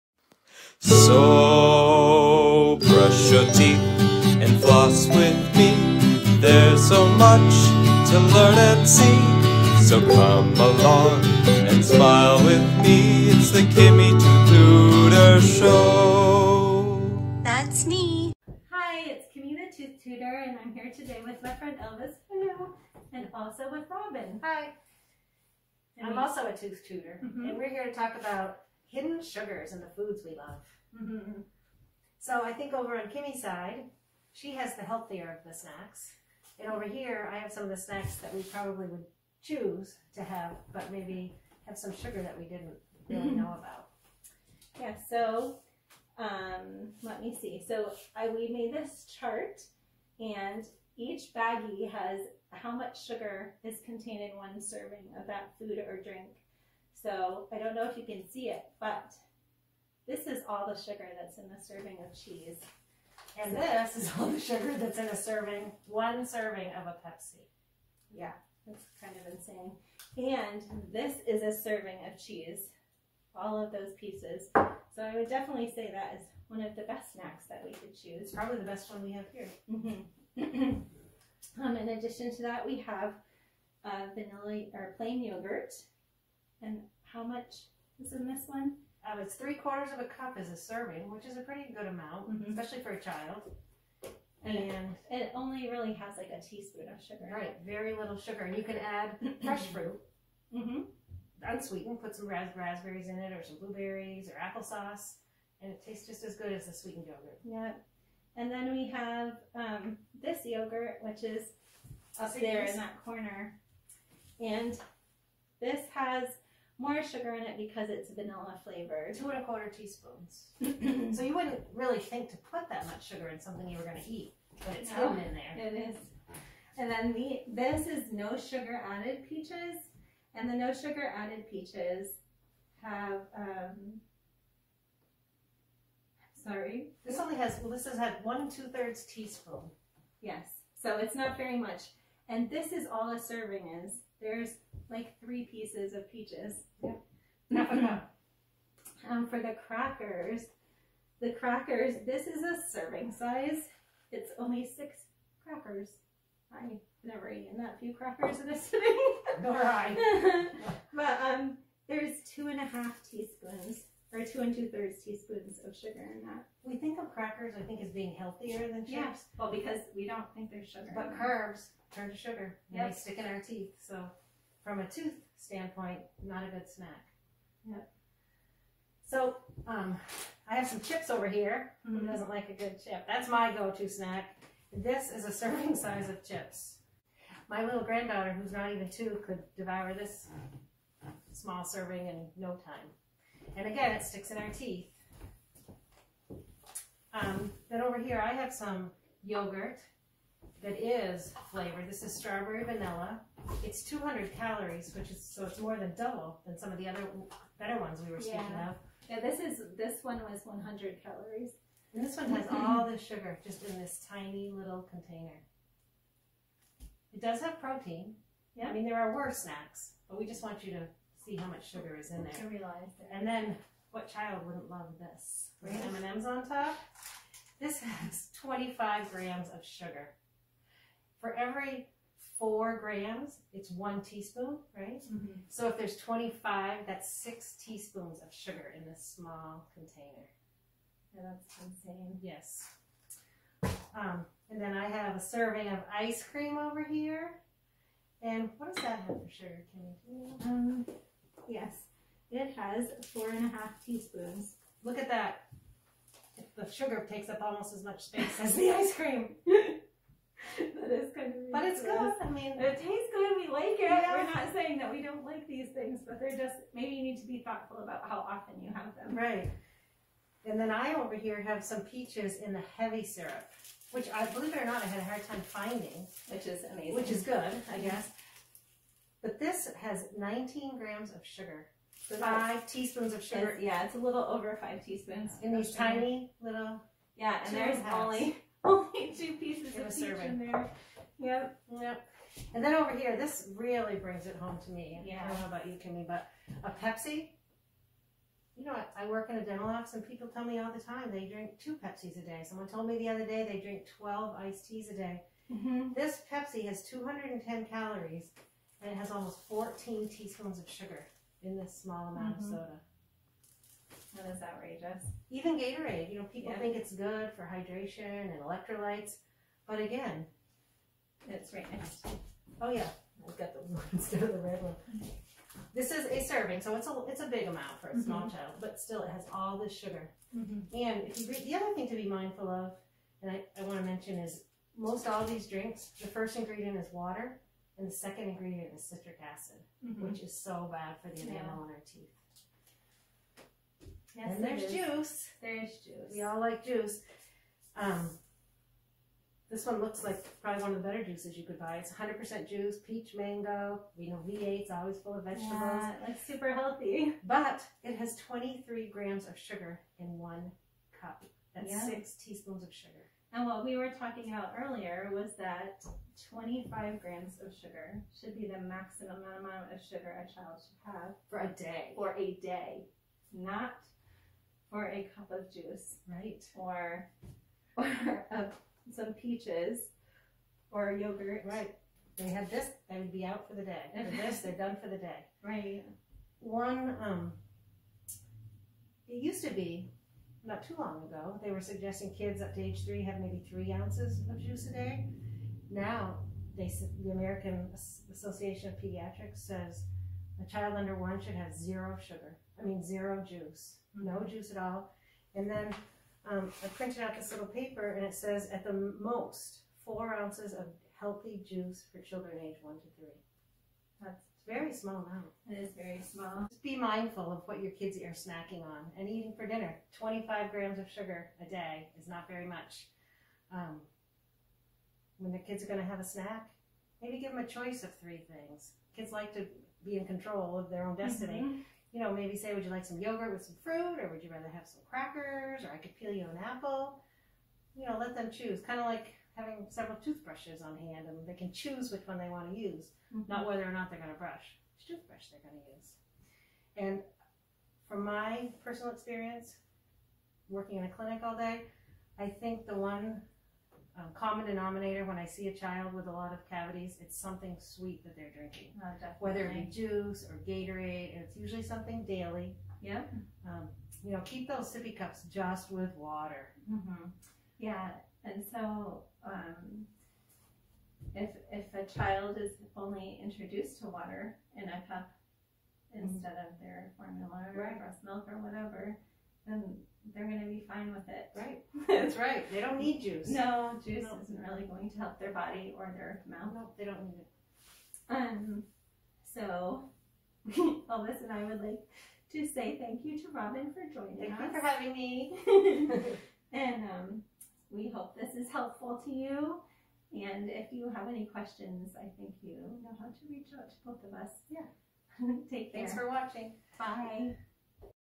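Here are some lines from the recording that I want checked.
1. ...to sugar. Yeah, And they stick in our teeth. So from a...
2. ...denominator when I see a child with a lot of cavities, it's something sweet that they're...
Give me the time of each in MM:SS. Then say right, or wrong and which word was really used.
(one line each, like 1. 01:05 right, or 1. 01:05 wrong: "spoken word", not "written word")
1. 02:52 right
2. 07:34 right.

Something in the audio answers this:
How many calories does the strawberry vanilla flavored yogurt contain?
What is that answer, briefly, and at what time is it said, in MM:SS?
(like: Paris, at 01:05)
200, at 03:23.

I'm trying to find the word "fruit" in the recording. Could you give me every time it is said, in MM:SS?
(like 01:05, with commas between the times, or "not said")
01:39, 07:13.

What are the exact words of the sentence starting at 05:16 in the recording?
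think it's good for hydration and electrolytes, but again, it's right next.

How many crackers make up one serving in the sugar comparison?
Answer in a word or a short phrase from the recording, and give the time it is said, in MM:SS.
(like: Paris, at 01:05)
6, at 02:34.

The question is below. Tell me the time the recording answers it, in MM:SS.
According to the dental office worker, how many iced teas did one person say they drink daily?
05:03.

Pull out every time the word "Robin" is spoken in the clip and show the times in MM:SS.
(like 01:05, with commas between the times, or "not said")
00:23, 08:13.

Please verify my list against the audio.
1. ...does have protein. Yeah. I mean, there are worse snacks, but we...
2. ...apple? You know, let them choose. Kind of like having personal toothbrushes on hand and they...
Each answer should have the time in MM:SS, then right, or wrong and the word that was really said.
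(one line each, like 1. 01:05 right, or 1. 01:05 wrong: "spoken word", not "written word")
1. 03:37 right
2. 07:16 wrong: "several", not "personal".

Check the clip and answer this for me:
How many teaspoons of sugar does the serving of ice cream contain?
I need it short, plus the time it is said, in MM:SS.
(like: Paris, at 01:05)
4 1/2 teaspoons, at 04:13.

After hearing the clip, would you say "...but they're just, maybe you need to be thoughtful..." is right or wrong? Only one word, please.
right.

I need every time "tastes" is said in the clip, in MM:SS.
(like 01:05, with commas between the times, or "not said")
01:45, 04:22.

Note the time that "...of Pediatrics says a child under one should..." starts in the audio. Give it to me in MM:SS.
06:38.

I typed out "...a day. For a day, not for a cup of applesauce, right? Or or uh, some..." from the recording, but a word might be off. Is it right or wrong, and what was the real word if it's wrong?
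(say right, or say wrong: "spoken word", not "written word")
wrong: "juice", not "applesauce".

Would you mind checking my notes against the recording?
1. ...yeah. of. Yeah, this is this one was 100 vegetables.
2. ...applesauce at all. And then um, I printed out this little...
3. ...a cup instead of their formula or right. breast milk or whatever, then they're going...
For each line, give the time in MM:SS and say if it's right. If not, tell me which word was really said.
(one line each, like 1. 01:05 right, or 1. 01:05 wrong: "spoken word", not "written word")
1. 03:28 wrong: "calories", not "vegetables"
2. 06:44 wrong: "juice", not "applesauce"
3. 07:54 right.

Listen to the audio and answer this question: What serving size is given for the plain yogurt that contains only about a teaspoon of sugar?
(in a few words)
3/4 cup.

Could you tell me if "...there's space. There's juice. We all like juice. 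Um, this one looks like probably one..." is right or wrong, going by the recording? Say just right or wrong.
wrong.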